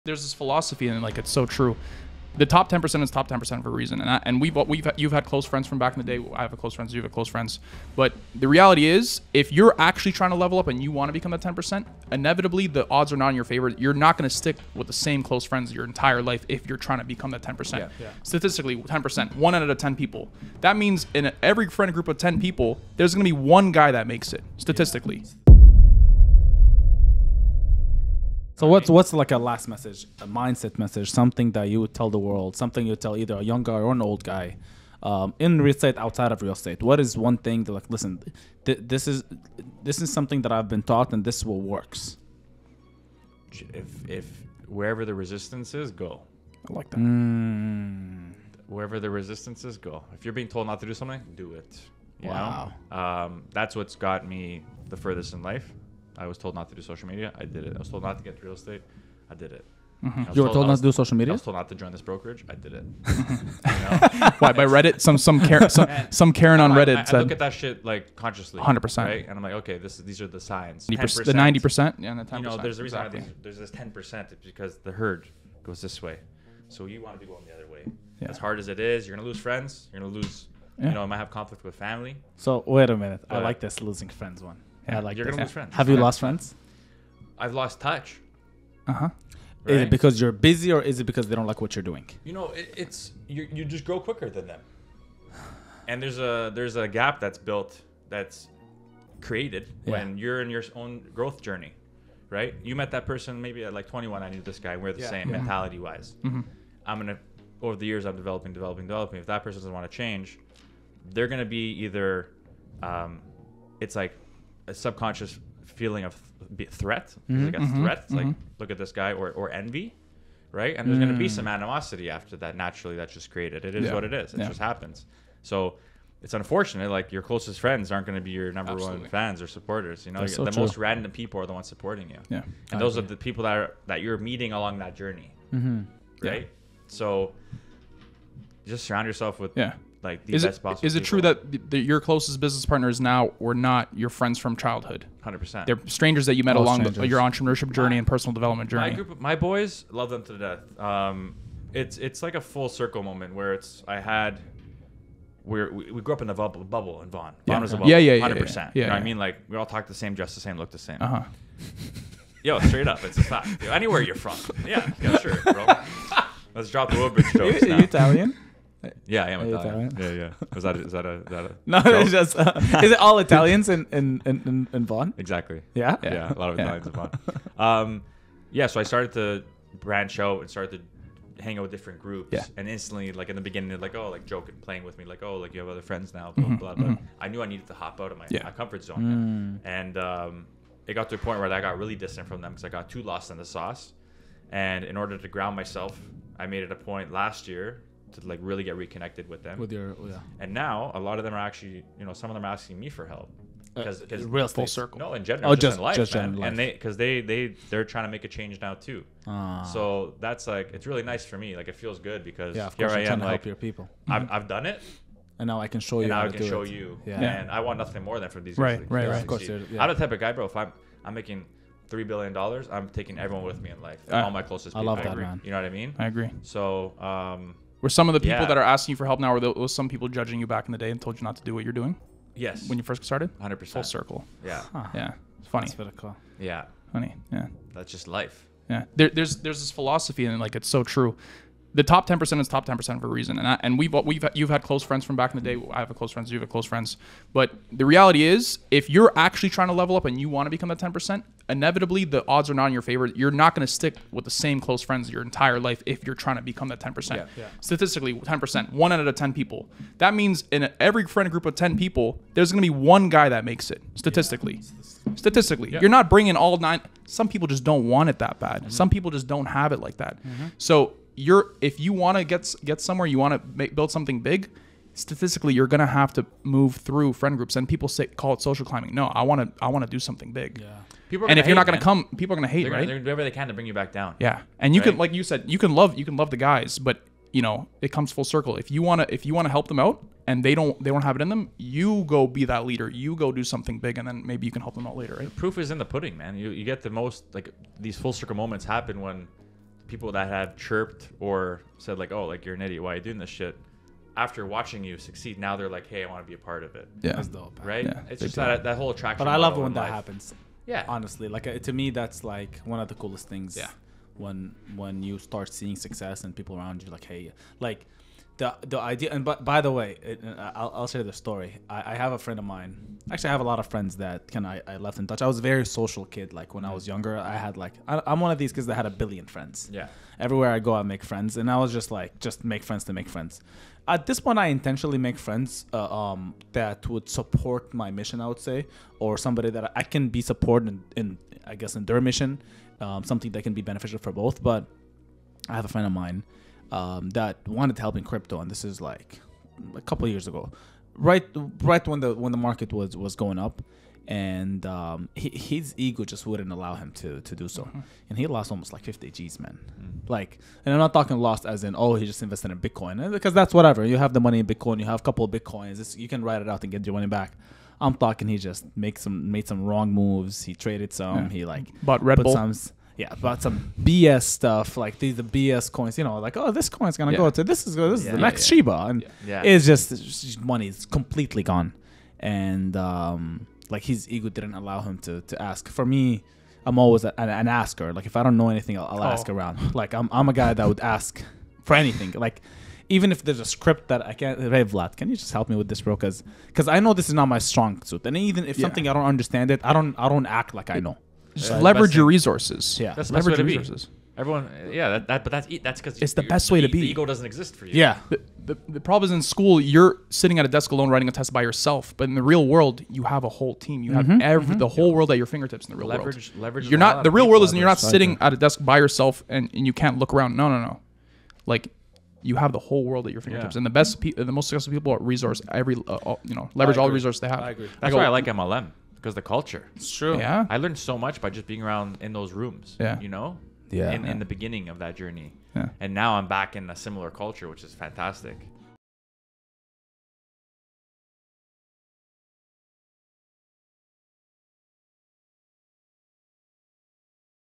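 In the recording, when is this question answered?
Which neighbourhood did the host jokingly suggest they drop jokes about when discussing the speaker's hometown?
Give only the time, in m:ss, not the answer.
2:46.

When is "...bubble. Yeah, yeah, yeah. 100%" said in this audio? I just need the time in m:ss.
2:37.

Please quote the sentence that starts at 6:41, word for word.
Just uh, That's leverage your thing.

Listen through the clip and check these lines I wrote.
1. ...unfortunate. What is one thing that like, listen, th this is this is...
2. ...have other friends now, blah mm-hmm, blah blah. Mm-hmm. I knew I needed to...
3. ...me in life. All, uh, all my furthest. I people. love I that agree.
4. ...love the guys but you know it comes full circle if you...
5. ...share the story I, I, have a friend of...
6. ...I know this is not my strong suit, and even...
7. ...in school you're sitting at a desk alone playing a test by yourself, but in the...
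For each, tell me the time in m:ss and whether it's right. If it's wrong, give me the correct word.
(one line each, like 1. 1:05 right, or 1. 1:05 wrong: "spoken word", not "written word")
1. 0:36 wrong: "estate", not "unfortunate"
2. 3:05 right
3. 3:43 wrong: "closest", not "furthest"
4. 4:46 right
5. 5:20 right
6. 6:36 right
7. 6:49 wrong: "writing", not "playing".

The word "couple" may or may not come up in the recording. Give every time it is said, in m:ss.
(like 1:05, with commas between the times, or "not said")
5:49, 6:05.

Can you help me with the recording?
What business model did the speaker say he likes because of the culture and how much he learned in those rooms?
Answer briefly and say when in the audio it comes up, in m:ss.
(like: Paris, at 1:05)
MLM, at 7:08.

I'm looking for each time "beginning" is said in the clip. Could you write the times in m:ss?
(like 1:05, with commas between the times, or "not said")
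3:03, 7:14.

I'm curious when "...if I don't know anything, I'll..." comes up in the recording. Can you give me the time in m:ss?
6:28.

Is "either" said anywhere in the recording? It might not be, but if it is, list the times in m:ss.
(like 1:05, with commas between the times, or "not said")
0:33, 1:51.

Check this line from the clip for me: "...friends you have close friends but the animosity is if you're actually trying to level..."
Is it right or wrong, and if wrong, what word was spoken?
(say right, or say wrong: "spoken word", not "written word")
wrong: "reality", not "animosity".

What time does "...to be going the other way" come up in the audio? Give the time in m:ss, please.
1:17.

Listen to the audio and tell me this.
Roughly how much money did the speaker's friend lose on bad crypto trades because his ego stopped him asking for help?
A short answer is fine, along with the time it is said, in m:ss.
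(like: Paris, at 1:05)
50 G's, at 5:58.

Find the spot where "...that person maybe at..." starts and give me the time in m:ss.
1:42.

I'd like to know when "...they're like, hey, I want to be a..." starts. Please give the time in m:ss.
5:05.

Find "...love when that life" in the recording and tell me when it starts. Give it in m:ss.
5:09.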